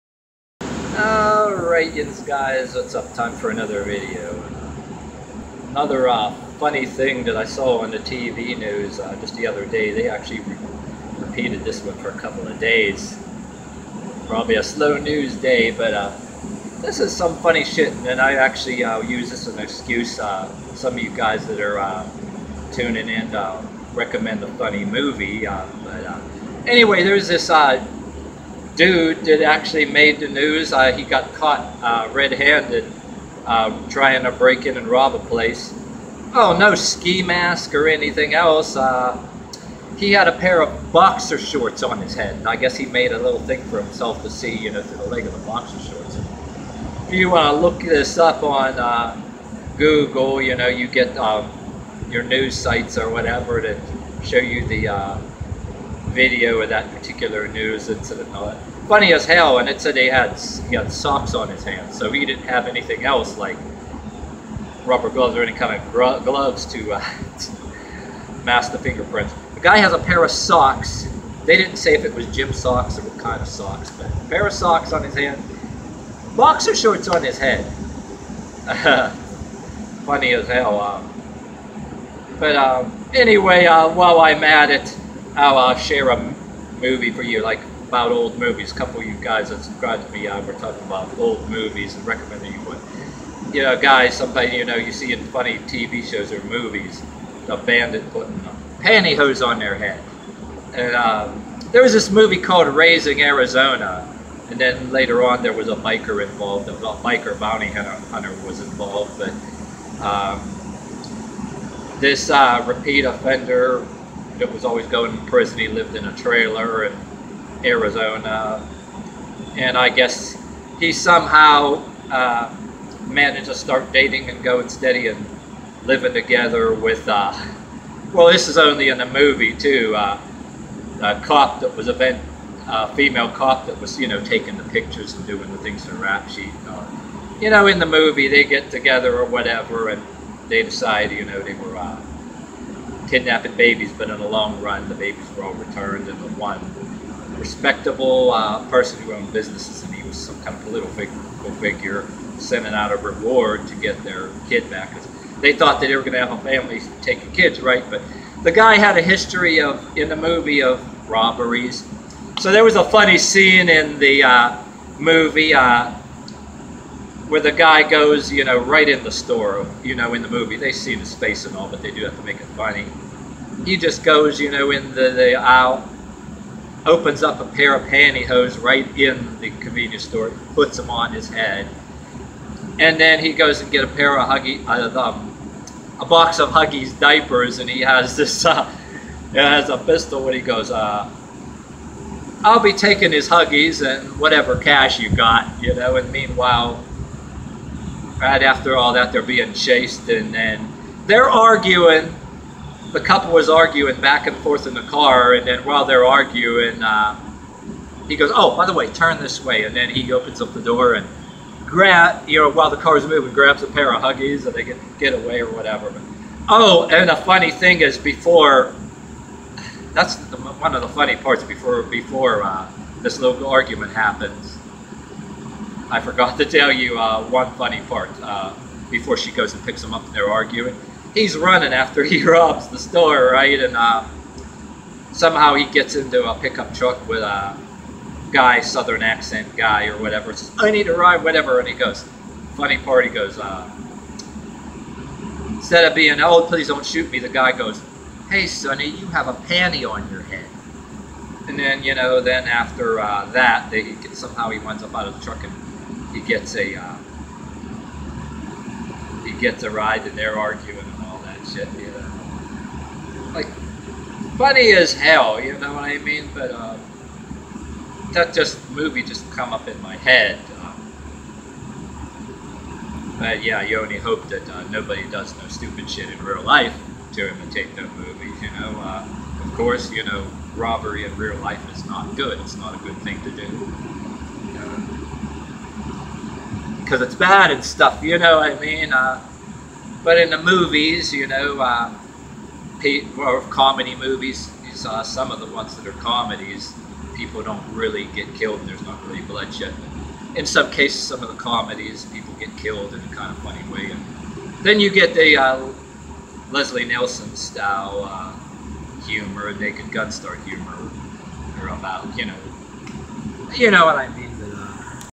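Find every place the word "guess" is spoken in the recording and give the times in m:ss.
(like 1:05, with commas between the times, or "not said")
0:42, 1:59.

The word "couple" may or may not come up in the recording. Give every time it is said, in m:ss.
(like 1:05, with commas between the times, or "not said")
0:12, 1:28, 3:22.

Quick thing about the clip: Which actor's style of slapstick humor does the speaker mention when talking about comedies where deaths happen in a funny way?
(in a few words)
Leslie Nielsen.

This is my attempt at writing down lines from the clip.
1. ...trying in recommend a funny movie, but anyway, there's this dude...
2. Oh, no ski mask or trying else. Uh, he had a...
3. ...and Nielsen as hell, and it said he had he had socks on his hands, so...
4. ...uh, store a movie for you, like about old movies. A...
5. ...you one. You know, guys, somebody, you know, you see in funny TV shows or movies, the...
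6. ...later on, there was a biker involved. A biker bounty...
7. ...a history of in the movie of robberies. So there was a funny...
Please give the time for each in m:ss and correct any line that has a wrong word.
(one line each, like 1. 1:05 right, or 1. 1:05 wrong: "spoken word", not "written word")
1. 0:22 wrong: "tuning", not "trying"
2. 0:36 wrong: "anything", not "trying"
3. 0:58 wrong: "Funny", not "Nielsen"
4. 1:25 wrong: "share", not "store"
5. 1:32 right
6. 1:44 right
7. 2:38 right.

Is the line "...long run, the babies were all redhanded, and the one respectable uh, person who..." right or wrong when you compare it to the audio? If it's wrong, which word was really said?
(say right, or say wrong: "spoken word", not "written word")
wrong: "returned", not "redhanded".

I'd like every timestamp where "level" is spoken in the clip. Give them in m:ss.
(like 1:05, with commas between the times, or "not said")
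not said.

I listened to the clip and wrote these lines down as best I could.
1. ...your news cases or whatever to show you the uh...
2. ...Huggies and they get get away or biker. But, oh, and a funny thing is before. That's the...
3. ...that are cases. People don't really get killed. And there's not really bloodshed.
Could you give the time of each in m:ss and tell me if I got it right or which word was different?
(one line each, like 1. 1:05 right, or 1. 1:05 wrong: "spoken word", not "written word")
1. 0:52 wrong: "sites", not "cases"
2. 3:34 wrong: "whatever", not "biker"
3. 4:55 wrong: "comedies", not "cases".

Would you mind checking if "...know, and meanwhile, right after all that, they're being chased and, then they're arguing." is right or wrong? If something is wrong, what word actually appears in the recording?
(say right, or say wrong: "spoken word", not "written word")
right.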